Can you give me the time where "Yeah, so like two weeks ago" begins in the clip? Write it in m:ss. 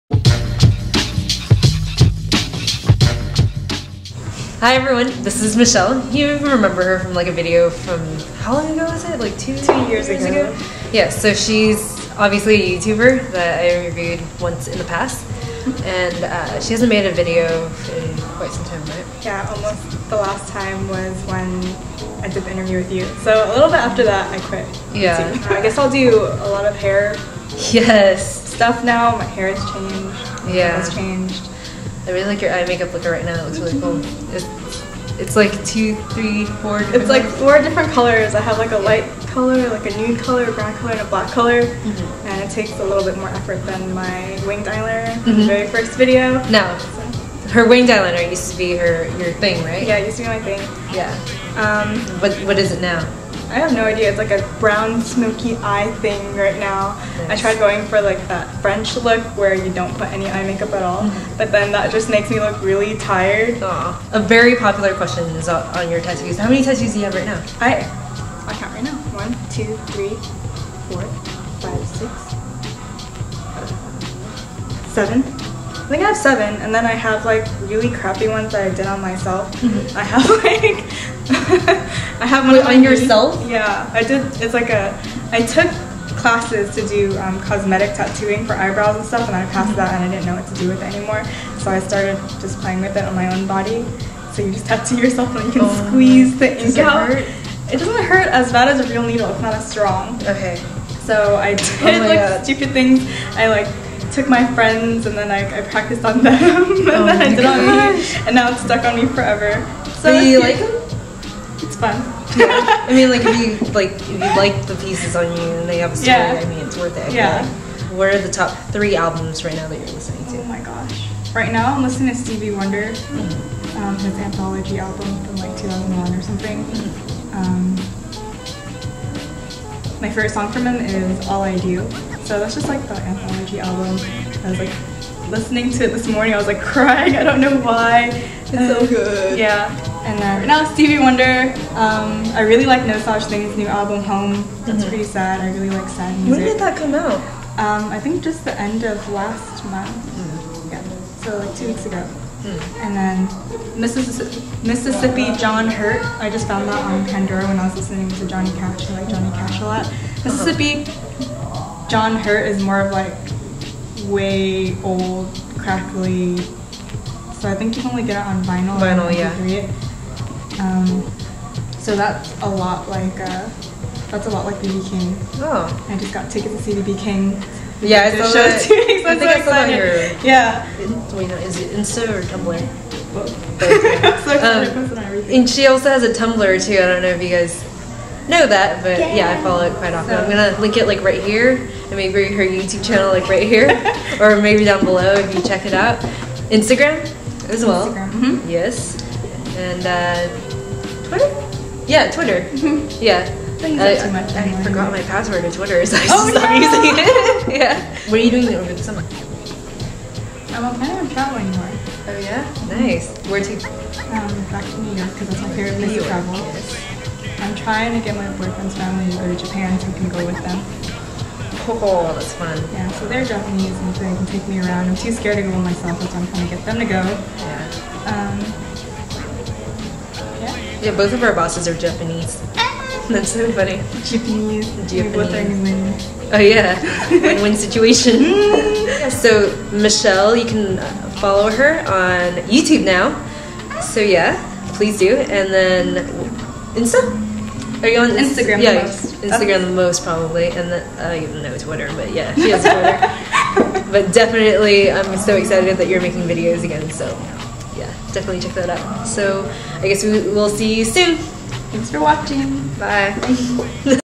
2:30.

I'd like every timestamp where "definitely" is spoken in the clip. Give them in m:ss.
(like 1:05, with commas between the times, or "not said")
4:14, 4:18.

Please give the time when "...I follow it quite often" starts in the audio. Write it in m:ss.
3:09.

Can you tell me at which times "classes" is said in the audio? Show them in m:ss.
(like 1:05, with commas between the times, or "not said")
1:26.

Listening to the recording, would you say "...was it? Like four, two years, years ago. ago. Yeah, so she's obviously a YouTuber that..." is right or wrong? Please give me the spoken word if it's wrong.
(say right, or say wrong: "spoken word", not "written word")
wrong: "two", not "four".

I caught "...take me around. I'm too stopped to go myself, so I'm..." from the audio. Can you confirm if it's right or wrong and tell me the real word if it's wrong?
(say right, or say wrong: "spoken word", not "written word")
wrong: "scared", not "stopped".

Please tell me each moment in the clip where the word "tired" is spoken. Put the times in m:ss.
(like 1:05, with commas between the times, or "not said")
1:02.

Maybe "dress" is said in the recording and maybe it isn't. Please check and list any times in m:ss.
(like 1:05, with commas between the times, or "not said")
not said.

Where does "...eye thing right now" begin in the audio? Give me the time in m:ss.
0:55.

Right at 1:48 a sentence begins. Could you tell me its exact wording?
on me and now it's stuck on me forever.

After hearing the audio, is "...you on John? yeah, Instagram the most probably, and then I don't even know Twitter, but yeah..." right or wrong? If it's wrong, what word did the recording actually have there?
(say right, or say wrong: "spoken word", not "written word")
wrong: "Instagram", not "John".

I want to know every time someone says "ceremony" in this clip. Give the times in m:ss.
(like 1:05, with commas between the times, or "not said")
not said.